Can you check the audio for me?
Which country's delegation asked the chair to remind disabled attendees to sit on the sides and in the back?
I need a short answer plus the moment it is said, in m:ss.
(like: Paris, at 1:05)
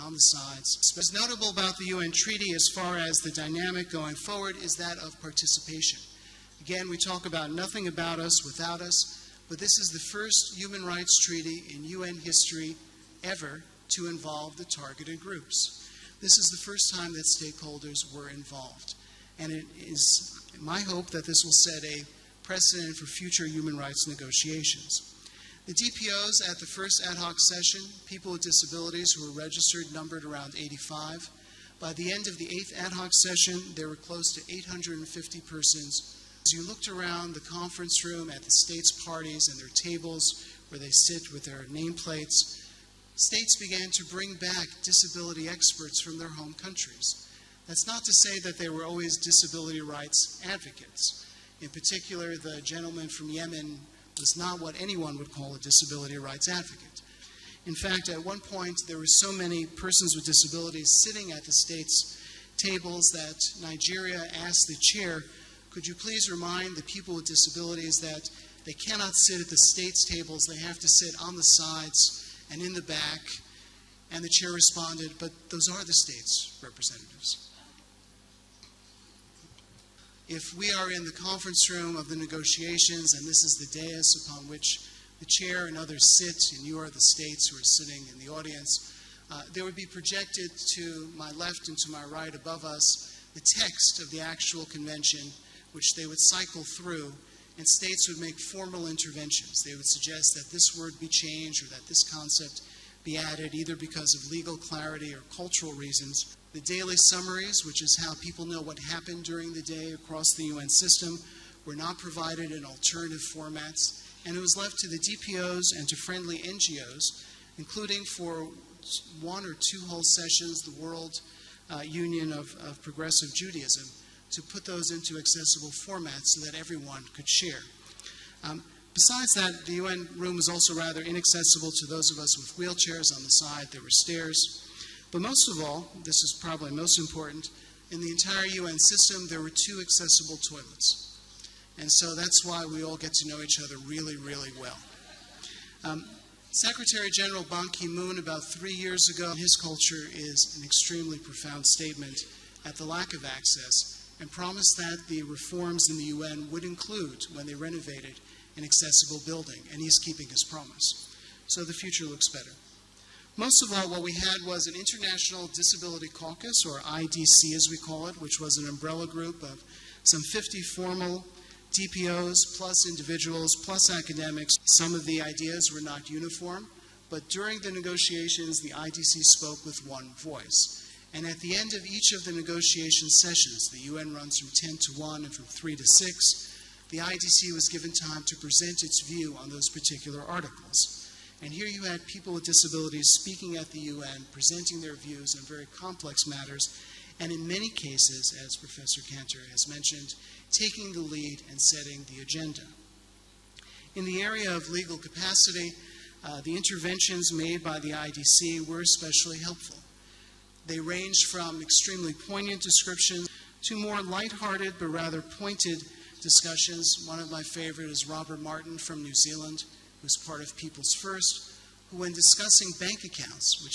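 Nigeria, at 1:03.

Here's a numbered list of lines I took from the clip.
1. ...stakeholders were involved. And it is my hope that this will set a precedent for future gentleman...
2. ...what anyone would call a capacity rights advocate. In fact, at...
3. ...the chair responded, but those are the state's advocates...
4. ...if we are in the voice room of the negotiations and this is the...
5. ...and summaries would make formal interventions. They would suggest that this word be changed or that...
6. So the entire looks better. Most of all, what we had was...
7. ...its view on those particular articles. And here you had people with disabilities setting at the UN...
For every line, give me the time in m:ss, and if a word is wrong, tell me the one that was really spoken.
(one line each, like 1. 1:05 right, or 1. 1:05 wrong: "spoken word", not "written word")
1. 0:17 wrong: "human", not "gentleman"
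2. 0:54 wrong: "disability", not "capacity"
3. 1:14 wrong: "representatives", not "advocates"
4. 1:20 wrong: "conference", not "voice"
5. 1:37 wrong: "states", not "summaries"
6. 2:41 wrong: "future", not "entire"
7. 3:08 wrong: "speaking", not "setting".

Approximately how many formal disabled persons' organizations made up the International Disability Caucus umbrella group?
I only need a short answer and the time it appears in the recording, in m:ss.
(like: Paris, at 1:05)
50, at 2:50.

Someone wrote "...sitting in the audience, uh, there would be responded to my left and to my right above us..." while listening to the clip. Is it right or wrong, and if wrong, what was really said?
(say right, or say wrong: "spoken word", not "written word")
wrong: "projected", not "responded".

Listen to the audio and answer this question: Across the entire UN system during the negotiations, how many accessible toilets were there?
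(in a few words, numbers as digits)
2.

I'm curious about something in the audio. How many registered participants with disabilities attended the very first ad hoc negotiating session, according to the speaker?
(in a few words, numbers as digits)
85.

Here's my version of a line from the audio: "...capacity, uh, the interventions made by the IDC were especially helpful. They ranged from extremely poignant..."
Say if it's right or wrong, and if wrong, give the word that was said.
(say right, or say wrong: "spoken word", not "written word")
right.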